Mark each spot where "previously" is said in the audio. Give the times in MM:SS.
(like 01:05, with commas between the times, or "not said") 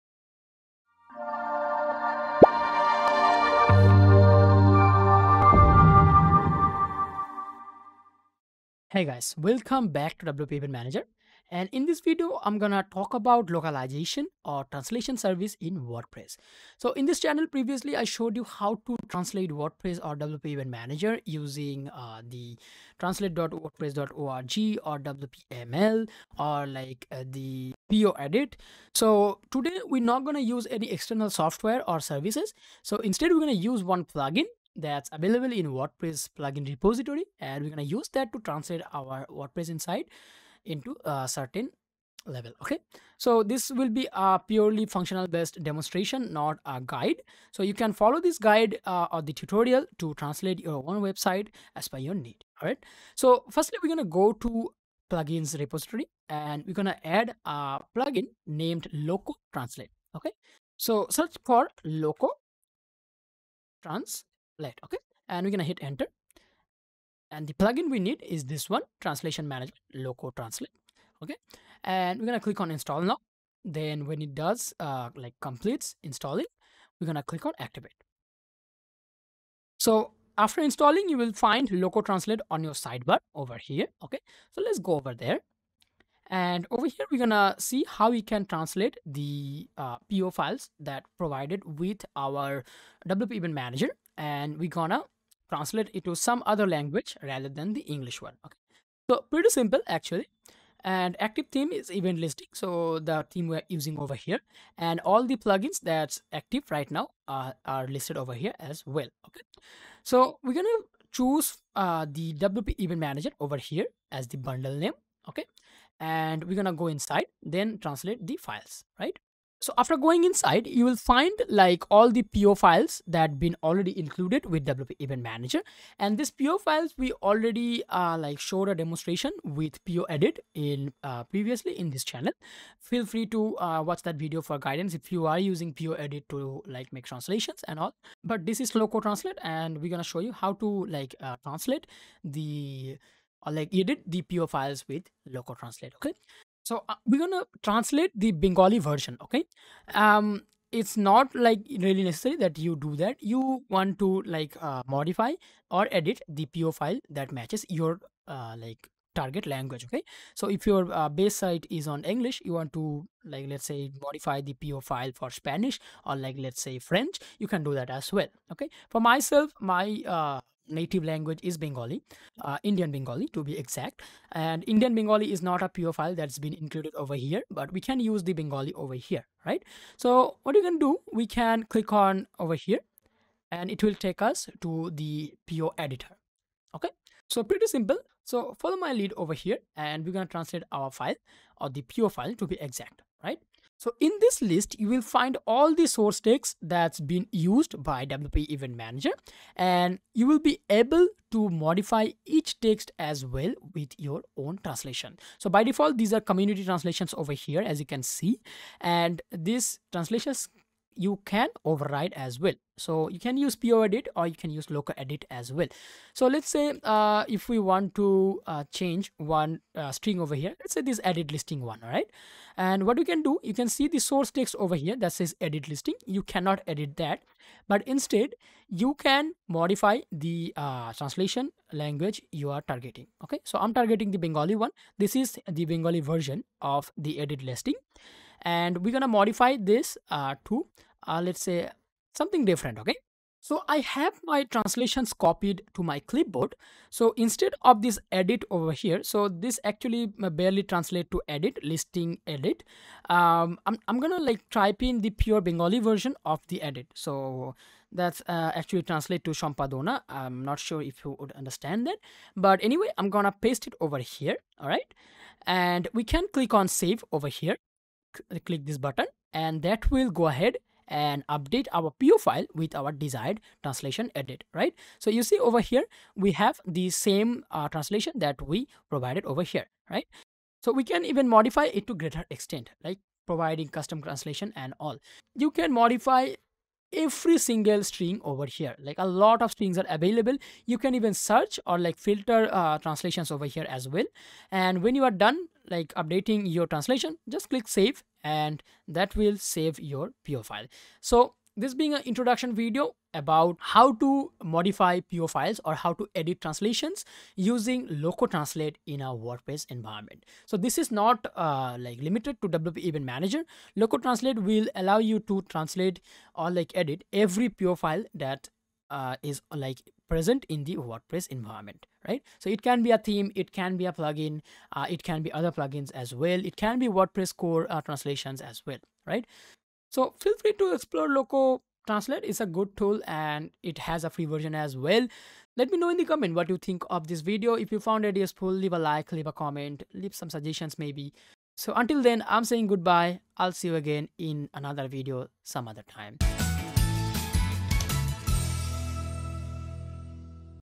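00:17, 02:11.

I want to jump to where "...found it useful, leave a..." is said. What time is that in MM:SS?
05:37.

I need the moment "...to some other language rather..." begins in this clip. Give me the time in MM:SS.
01:36.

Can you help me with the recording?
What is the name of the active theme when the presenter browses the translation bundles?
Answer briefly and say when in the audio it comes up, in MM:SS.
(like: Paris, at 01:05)
Event Listing, at 01:41.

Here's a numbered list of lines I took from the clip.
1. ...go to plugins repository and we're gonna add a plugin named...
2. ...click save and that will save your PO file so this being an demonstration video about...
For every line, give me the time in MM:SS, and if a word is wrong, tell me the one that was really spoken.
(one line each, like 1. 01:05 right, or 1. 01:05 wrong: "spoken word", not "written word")
1. 00:54 right
2. 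04:57 wrong: "introduction", not "demonstration".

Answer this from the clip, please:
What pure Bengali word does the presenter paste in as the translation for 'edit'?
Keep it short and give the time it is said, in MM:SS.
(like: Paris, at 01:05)
Shampadona, at 04:19.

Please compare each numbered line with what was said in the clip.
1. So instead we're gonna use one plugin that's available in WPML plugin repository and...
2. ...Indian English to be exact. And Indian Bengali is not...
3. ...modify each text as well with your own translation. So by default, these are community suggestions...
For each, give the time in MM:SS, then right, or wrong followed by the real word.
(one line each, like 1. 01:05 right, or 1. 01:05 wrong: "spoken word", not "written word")
1. 00:32 wrong: "WordPress", not "WPML"
2. 02:52 wrong: "Bengali", not "English"
3. 03:21 wrong: "translations", not "suggestions".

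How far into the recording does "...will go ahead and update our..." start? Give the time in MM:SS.
04:29.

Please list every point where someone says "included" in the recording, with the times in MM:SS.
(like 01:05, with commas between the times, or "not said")
02:03, 02:56.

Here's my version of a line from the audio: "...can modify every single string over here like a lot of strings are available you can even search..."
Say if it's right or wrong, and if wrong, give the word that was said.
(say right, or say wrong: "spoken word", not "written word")
right.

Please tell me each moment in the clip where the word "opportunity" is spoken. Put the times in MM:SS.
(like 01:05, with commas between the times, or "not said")
not said.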